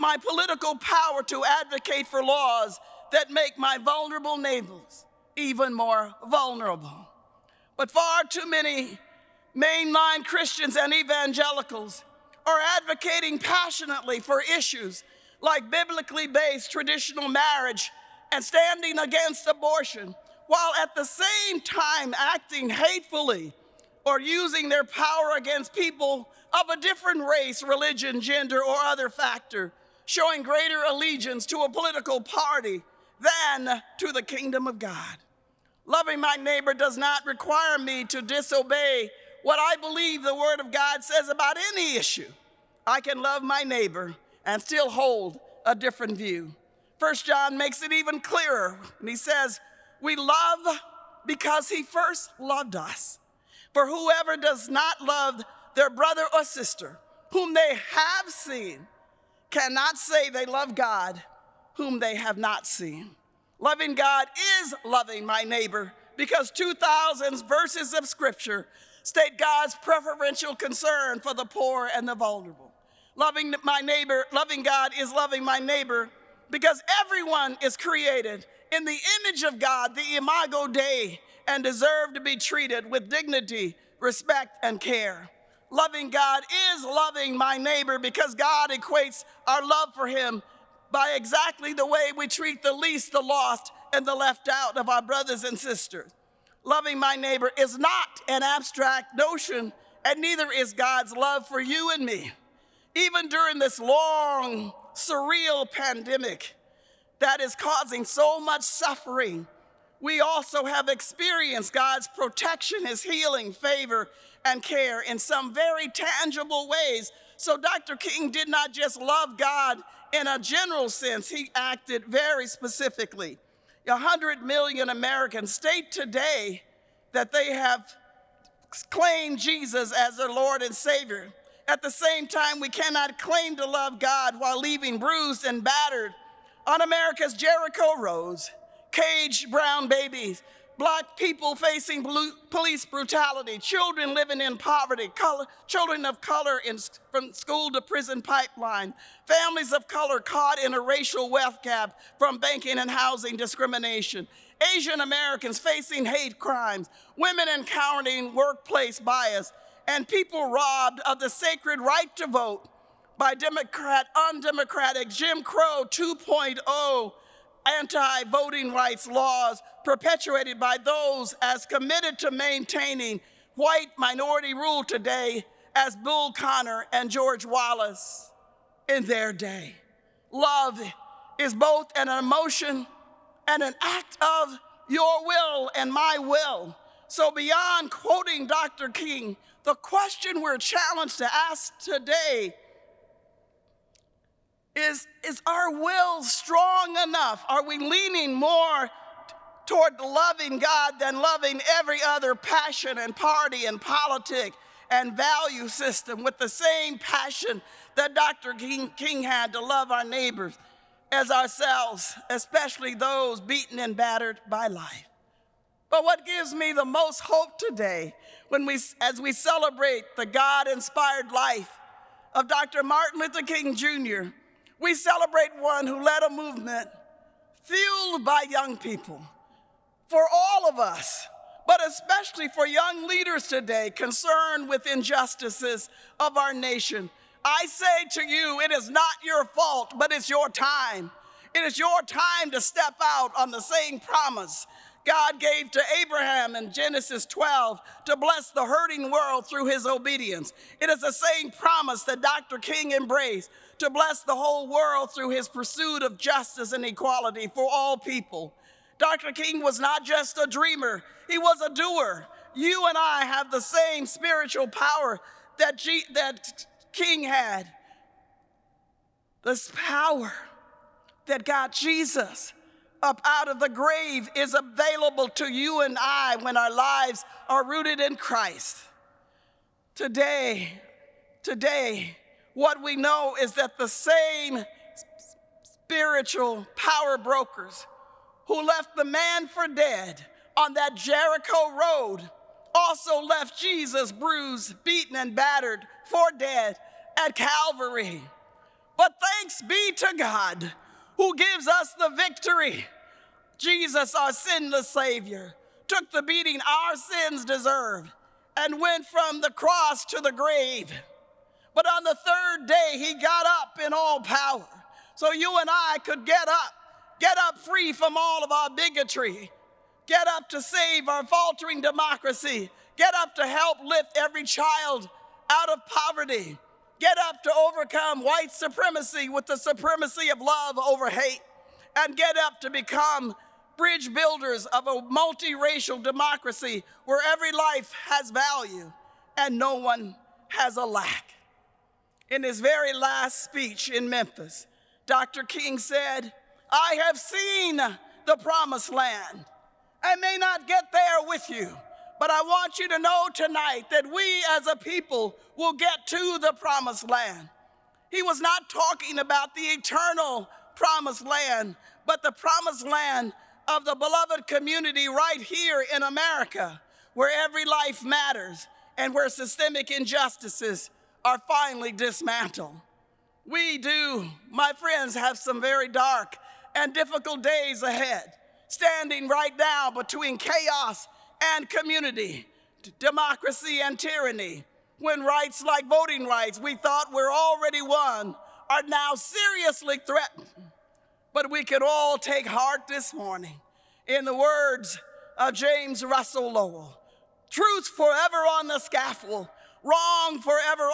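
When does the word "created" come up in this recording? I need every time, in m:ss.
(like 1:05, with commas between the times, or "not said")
1:17.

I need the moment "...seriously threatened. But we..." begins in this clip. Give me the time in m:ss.
6:29.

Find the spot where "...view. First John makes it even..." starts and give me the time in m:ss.
0:46.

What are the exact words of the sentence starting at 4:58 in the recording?
But thanks be to God who gives us the victory.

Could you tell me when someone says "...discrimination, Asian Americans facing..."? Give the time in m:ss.
2:33.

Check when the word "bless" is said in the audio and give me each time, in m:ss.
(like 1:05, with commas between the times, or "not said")
4:08, 4:13.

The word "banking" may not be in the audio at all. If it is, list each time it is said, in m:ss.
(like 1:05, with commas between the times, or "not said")
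2:32.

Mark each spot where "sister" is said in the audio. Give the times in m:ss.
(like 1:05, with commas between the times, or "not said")
0:56, 1:35.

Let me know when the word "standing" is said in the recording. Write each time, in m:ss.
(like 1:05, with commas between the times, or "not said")
0:18, 6:18.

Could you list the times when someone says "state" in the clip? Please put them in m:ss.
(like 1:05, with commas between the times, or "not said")
1:09, 2:05.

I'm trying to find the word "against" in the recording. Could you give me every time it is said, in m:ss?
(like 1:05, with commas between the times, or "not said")
0:18, 0:25.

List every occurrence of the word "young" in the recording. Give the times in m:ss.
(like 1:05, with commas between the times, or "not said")
3:48, 3:52.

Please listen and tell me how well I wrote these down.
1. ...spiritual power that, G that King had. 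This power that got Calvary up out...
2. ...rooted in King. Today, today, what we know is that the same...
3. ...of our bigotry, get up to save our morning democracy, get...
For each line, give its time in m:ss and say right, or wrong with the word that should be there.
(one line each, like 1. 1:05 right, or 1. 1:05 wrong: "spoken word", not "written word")
1. 4:24 wrong: "Jesus", not "Calvary"
2. 4:37 wrong: "Christ", not "King"
3. 5:18 wrong: "faltering", not "morning".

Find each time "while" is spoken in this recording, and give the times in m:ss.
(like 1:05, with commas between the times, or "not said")
0:20, 2:14.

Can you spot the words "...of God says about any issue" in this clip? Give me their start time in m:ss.
0:40.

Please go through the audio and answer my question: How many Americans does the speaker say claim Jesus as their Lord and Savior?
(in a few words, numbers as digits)
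100 million.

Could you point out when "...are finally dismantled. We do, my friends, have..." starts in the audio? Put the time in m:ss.
6:11.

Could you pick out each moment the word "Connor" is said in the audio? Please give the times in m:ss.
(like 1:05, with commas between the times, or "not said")
2:56.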